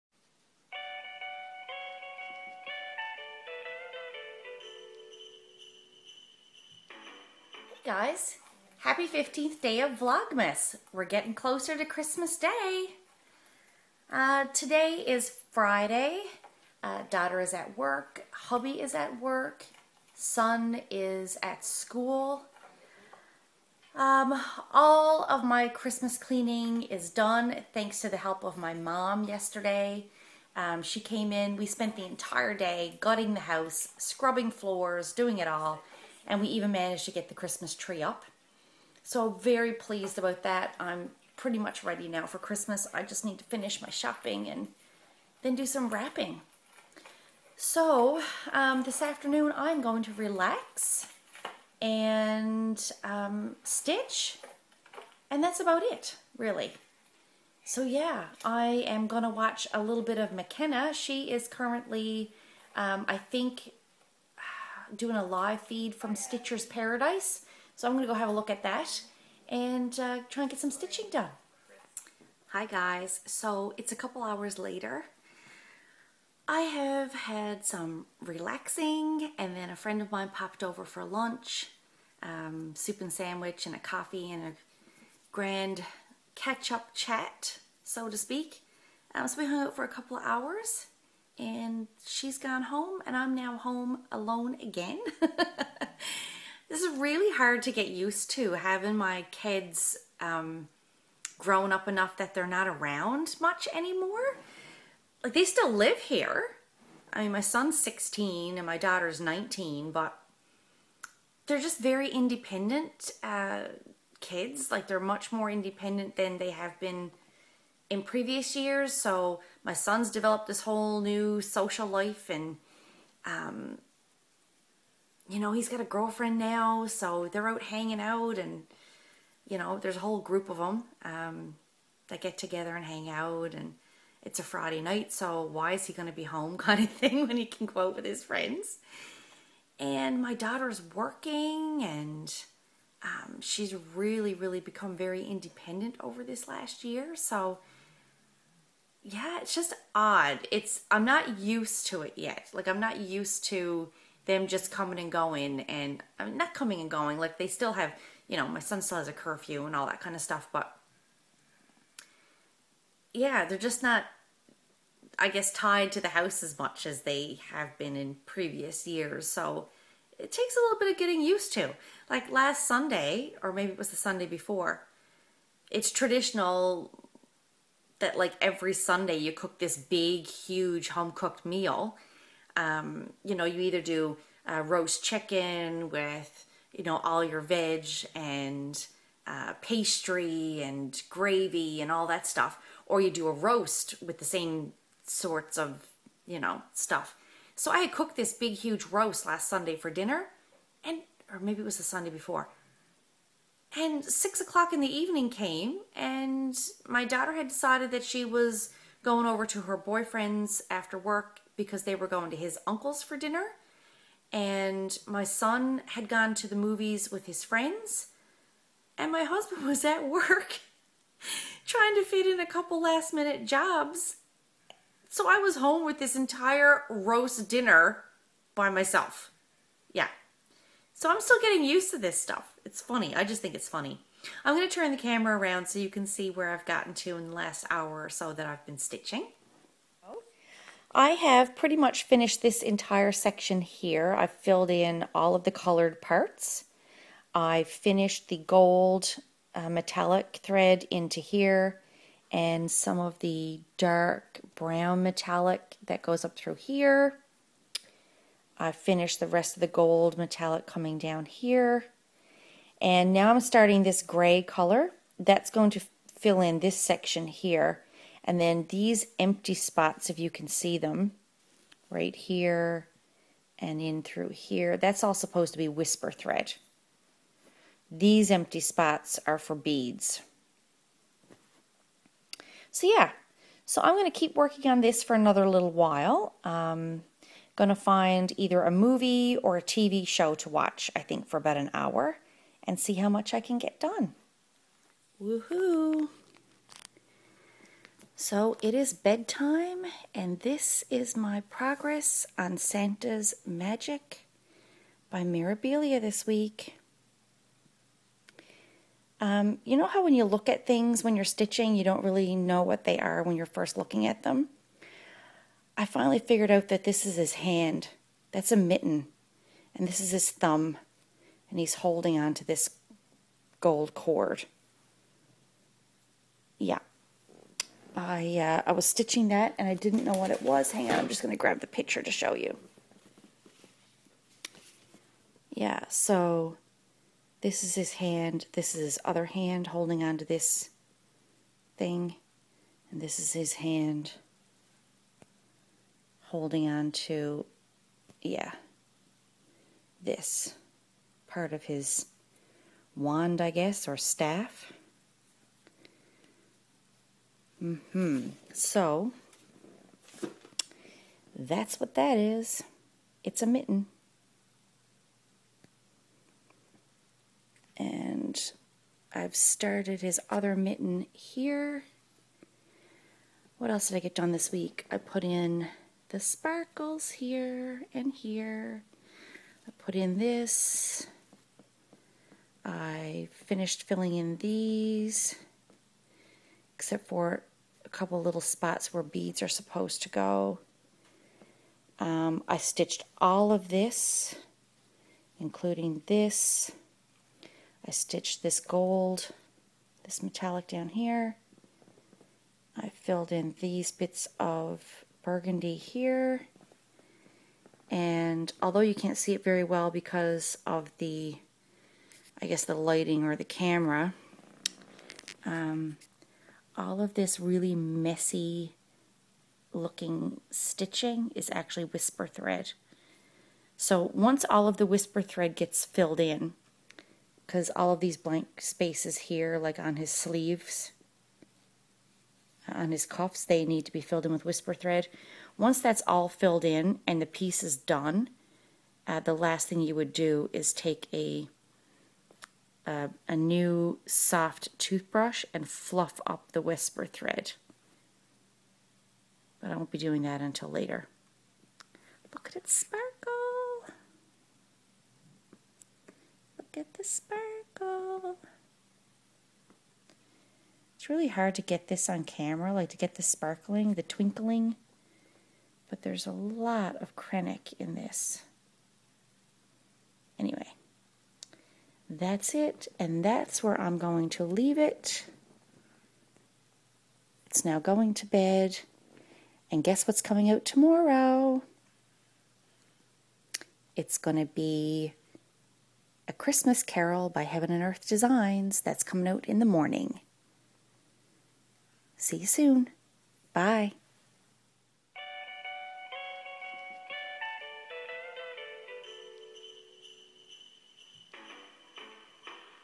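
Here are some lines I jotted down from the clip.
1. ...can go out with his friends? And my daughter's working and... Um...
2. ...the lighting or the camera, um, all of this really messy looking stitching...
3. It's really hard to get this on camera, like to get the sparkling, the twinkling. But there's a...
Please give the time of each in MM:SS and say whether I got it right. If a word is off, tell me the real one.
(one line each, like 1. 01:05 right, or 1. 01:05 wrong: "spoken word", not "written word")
1. 02:17 right
2. 06:52 right
3. 07:41 right.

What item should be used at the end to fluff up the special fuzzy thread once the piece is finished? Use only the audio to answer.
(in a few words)
Soft toothbrush.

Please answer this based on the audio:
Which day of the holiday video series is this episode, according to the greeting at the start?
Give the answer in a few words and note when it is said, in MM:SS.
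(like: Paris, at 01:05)
15th, at 00:09.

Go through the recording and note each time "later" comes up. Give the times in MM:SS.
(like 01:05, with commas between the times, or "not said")
01:14, 07:30.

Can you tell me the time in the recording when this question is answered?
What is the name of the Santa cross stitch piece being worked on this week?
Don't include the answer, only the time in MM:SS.
05:02.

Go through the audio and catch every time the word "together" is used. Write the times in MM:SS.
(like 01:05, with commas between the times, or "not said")
02:12.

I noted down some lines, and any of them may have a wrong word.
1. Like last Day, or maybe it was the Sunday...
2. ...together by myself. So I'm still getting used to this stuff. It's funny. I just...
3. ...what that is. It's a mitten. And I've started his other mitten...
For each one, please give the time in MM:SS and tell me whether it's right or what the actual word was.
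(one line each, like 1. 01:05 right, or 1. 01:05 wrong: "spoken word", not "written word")
1. 02:52 wrong: "Sunday", not "Day"
2. 03:47 wrong: "dinner", not "together"
3. 06:01 right.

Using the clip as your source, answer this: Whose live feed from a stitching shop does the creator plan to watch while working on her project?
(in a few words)
McKenna.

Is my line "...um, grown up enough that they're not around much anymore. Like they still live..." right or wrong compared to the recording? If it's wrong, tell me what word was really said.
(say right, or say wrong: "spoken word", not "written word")
right.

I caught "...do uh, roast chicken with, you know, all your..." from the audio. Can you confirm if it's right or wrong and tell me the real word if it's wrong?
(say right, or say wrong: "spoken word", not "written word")
right.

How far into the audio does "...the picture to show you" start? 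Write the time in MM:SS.
05:31.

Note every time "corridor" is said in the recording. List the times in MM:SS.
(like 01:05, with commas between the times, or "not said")
not said.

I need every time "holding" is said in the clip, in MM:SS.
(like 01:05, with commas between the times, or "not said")
05:21, 05:39, 05:46.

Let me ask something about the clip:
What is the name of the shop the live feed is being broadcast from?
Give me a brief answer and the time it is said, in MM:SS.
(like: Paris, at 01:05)
Stitcher's Paradise, at 01:06.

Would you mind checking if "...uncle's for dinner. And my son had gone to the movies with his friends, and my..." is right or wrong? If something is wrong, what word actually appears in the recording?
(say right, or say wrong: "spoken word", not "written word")
right.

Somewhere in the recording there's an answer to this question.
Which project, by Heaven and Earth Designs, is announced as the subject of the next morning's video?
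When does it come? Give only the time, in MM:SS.
08:06.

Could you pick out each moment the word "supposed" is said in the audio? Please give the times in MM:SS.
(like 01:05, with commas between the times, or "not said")
04:35, 06:29.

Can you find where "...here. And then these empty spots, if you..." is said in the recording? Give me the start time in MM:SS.
04:27.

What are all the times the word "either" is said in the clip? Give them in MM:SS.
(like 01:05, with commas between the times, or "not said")
03:03, 04:48.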